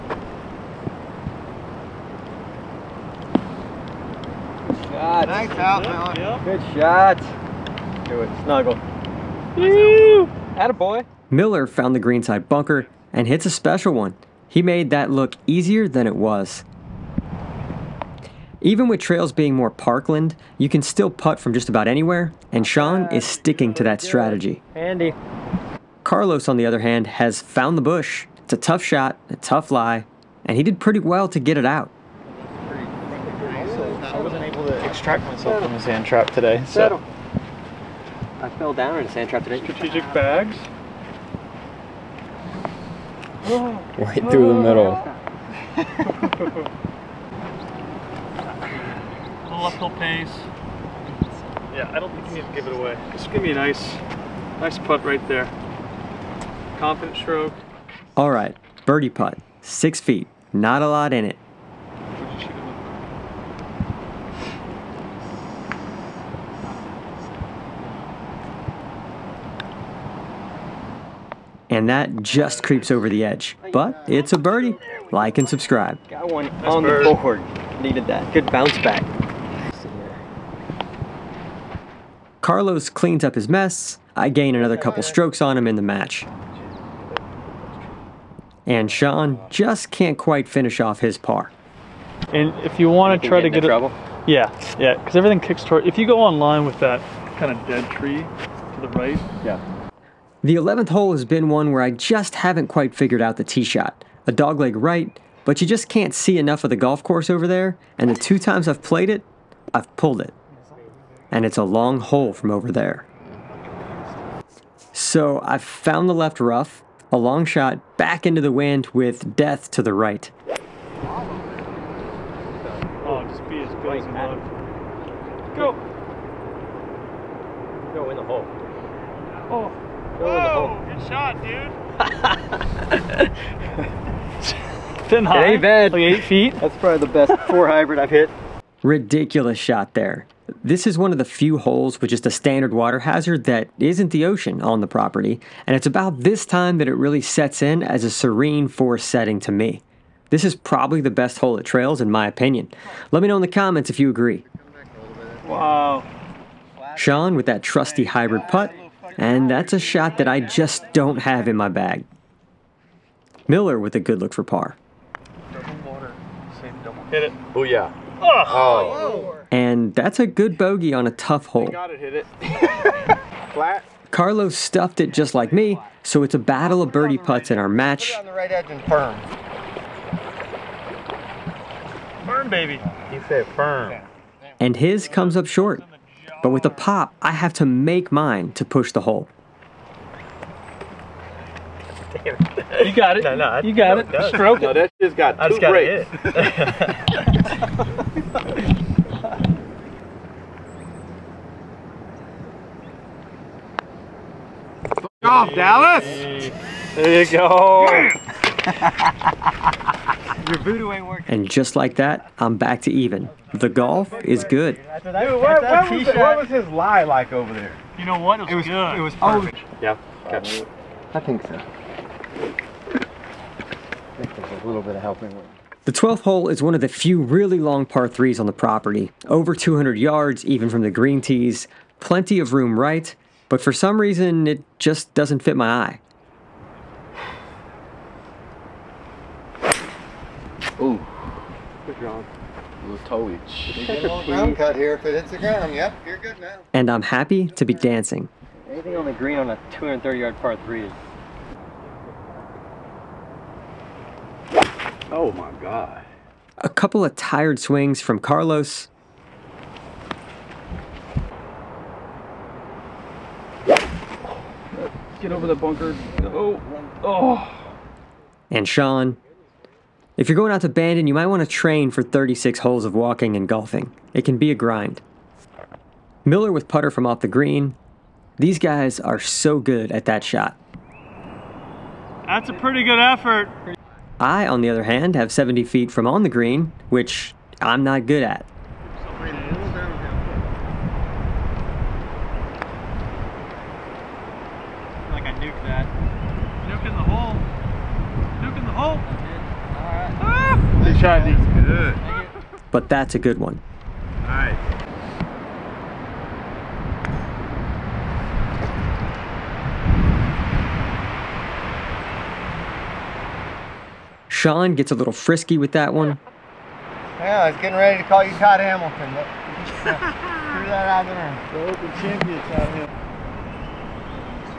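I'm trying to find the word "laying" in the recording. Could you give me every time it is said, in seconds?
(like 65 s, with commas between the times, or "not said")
not said.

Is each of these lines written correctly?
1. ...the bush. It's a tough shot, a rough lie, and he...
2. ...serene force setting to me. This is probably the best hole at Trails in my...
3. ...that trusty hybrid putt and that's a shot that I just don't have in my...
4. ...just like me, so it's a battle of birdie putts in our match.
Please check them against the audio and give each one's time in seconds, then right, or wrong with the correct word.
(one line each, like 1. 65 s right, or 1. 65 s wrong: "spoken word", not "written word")
1. 27 s wrong: "tough", not "rough"
2. 148 s right
3. 157 s right
4. 175 s right.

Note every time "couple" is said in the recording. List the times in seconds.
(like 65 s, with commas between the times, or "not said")
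84 s, 256 s.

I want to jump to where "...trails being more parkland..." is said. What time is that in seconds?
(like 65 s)
18 s.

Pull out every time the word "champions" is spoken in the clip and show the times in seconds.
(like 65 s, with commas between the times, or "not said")
321 s.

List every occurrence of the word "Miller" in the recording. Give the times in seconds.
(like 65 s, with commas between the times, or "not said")
11 s, 163 s, 276 s.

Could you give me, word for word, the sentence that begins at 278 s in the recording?
These guys are so good at that shot.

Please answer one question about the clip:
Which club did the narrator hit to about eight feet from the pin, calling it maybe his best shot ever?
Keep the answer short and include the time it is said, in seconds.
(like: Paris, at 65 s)
four hybrid, at 137 s.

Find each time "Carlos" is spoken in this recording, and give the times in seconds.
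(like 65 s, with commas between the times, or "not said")
26 s, 82 s, 174 s, 258 s.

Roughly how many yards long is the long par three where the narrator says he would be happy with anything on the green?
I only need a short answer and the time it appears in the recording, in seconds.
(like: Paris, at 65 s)
230, at 249 s.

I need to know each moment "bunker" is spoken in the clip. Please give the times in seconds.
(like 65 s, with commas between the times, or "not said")
12 s, 265 s.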